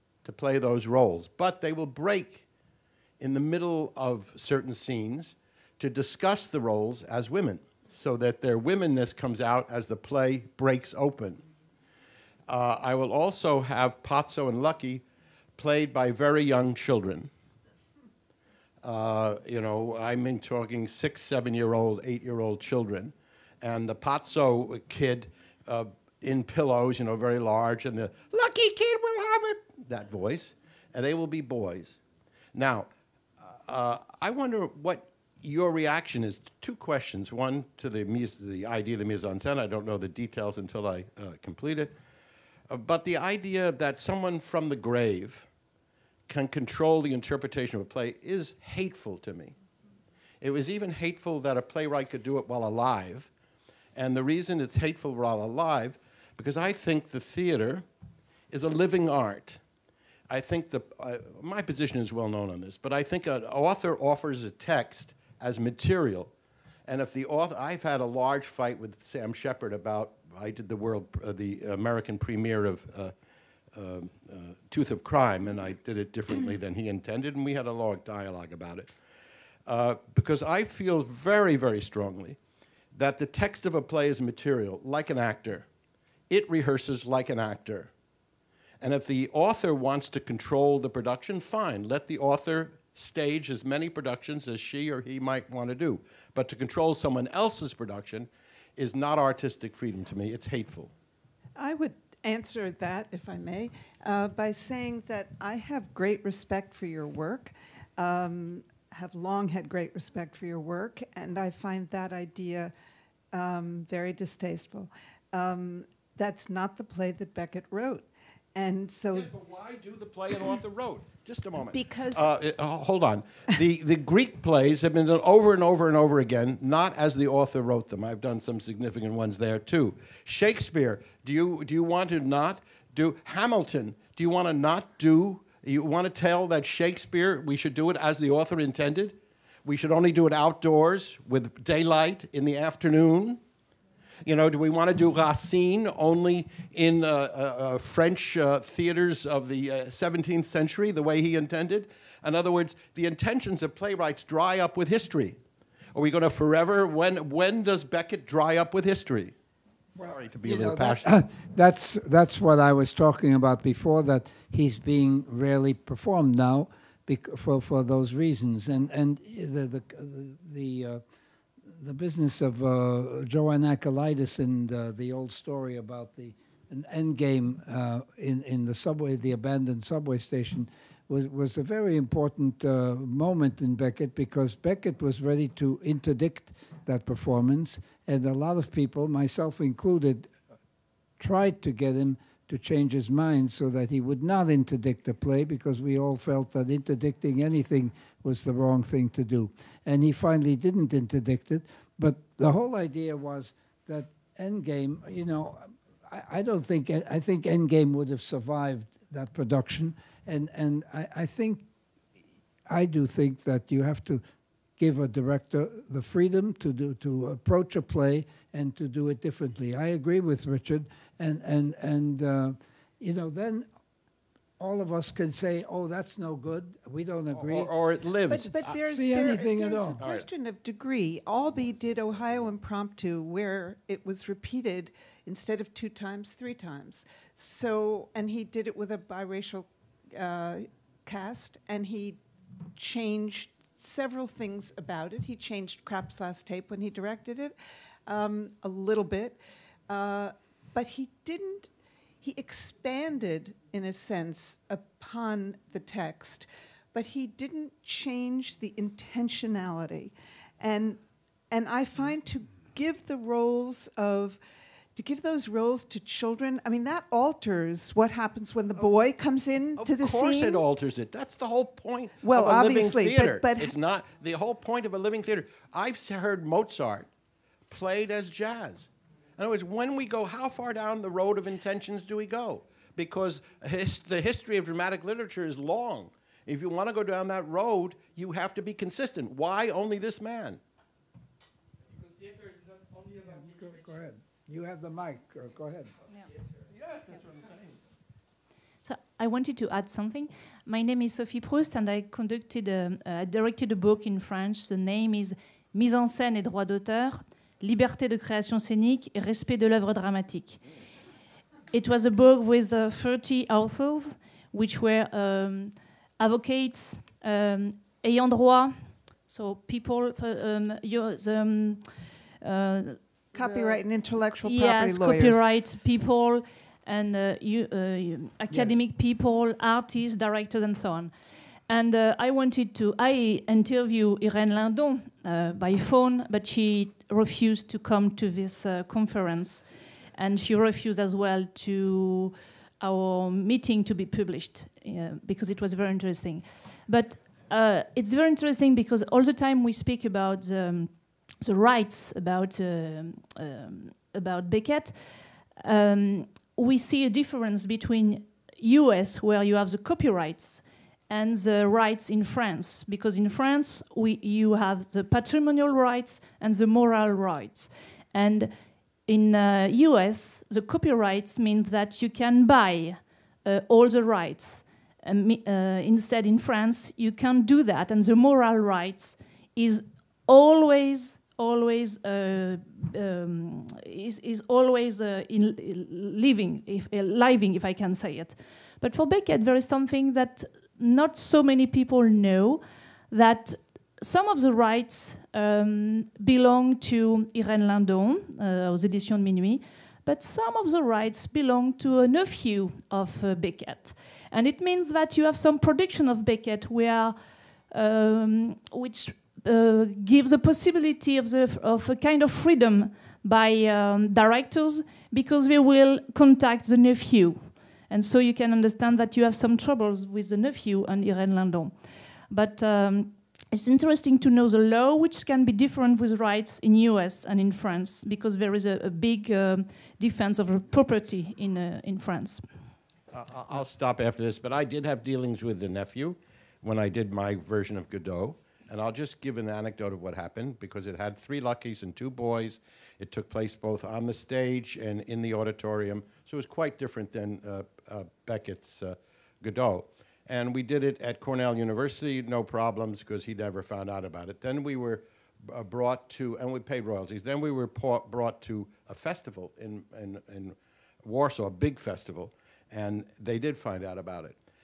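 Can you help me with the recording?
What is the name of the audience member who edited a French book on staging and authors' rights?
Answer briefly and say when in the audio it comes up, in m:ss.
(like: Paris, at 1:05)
Sophie Proust, at 5:01.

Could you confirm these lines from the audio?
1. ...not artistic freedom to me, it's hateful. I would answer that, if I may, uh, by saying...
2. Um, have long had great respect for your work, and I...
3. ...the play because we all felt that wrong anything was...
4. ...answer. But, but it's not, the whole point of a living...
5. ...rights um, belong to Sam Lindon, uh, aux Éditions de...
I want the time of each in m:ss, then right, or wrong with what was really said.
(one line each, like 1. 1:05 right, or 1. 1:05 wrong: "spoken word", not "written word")
1. 1:38 right
2. 1:47 right
3. 3:15 wrong: "interdicting", not "wrong"
4. 4:33 wrong: "theater", not "answer"
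5. 6:34 wrong: "Irène", not "Sam".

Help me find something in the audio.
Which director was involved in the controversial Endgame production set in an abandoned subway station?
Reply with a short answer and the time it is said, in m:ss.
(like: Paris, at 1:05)
JoAnne Akalitis, at 2:53.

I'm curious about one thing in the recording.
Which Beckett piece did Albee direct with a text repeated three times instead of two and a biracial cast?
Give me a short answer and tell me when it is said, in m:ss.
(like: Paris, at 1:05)
Ohio Impromptu, at 3:51.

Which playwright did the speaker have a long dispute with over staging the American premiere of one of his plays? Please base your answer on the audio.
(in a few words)
Sam Shepard.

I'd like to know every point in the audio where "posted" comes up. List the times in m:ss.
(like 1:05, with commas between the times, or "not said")
not said.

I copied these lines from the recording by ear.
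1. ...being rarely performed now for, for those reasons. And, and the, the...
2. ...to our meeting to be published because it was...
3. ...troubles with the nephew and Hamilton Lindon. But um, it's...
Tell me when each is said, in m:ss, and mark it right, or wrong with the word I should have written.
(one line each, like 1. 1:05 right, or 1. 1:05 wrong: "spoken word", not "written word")
1. 2:44 right
2. 5:41 right
3. 6:59 wrong: "Irene", not "Hamilton".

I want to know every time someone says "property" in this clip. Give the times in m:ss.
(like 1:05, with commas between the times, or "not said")
5:24, 7:10.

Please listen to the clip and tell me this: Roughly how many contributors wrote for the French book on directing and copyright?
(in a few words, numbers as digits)
30.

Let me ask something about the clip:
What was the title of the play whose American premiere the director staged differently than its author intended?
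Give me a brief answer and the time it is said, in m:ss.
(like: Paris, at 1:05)
Tooth of Crime, at 1:14.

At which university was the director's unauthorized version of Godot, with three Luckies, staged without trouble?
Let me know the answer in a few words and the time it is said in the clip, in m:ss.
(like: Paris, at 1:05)
Cornell University, at 7:31.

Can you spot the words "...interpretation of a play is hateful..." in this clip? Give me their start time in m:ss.
0:47.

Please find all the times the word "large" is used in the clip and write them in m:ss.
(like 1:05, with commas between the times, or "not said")
0:27, 1:08.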